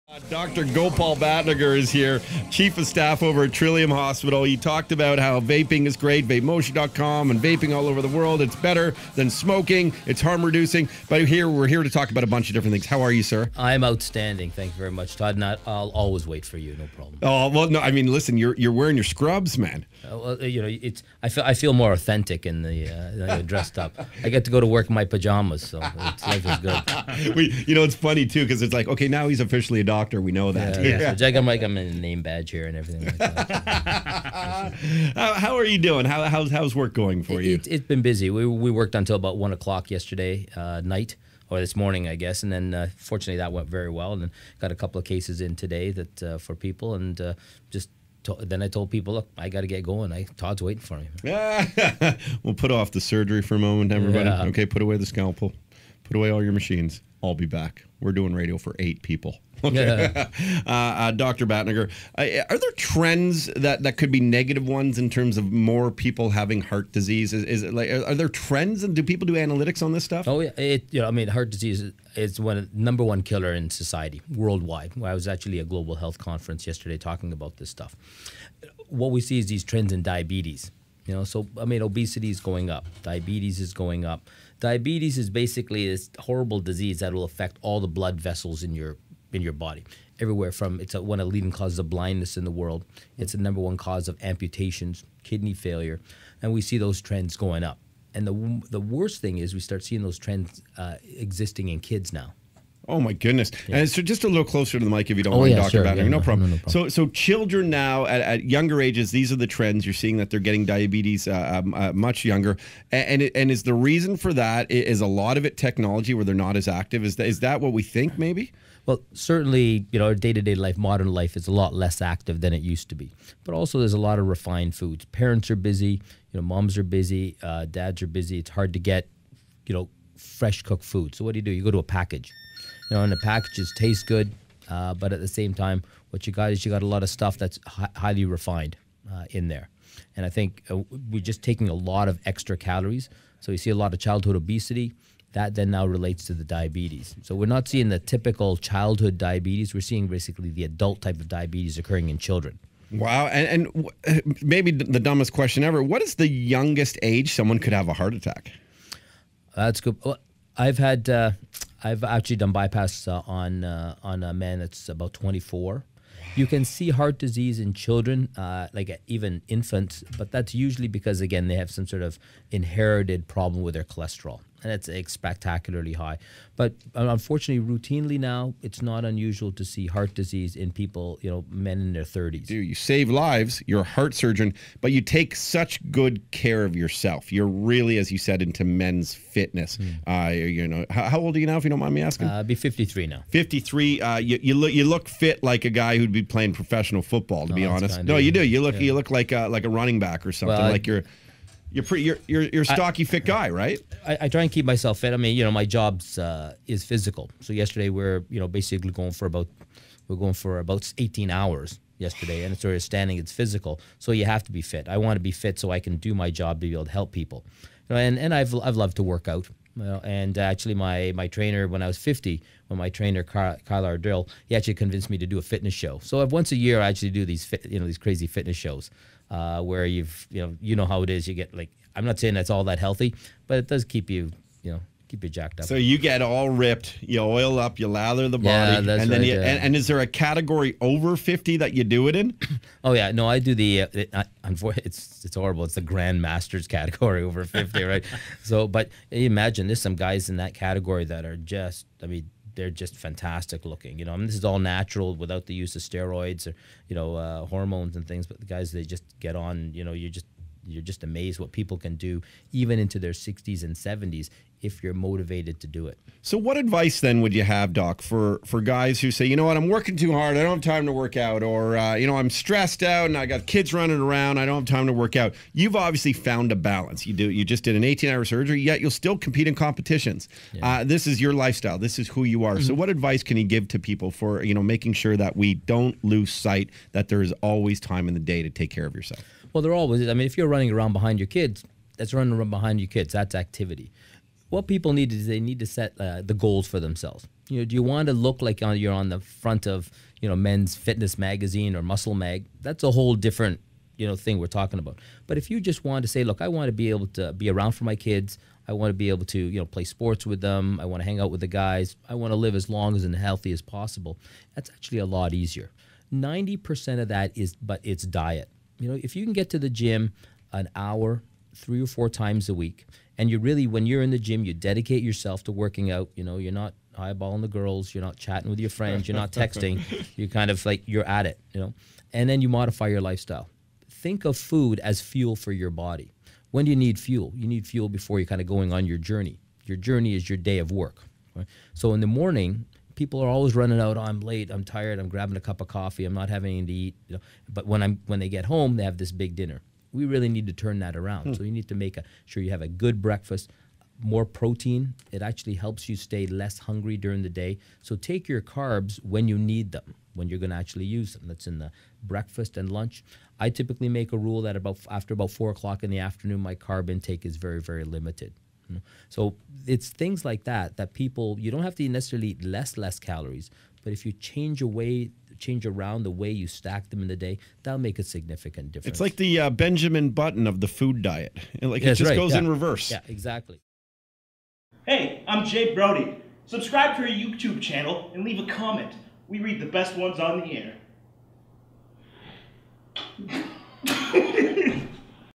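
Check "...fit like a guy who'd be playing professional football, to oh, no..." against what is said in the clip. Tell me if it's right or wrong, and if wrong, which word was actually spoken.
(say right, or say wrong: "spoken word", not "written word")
right.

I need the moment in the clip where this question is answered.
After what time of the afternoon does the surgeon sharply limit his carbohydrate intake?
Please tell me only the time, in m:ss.
6:05.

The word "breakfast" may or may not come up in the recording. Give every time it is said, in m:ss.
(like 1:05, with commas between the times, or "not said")
5:53, 6:02.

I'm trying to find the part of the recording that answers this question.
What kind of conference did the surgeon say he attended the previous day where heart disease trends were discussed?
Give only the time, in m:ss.
1:15.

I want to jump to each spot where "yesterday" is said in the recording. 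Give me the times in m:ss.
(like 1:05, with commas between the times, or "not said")
0:39, 1:16, 3:27, 3:31.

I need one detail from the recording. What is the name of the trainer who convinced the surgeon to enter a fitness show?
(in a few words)
Kyle Ardell.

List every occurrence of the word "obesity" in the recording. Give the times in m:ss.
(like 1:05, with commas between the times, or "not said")
1:21, 2:24.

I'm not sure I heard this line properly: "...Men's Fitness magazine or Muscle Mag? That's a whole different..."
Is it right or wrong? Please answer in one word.
right.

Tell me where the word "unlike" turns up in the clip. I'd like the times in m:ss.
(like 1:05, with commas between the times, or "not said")
not said.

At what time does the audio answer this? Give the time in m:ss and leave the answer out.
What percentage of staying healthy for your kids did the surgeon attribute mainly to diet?
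5:16.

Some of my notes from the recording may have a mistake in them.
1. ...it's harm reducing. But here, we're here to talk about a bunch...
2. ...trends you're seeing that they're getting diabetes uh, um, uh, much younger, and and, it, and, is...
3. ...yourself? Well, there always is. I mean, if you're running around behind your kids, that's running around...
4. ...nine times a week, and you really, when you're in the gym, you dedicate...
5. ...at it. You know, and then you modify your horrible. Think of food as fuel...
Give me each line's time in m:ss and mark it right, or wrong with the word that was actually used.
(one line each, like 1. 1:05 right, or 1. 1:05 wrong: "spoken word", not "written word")
1. 0:10 right
2. 1:49 right
3. 4:48 right
4. 5:21 wrong: "four", not "nine"
5. 5:31 wrong: "lifestyle", not "horrible".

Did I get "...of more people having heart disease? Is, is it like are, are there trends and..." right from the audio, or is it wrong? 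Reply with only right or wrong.
right.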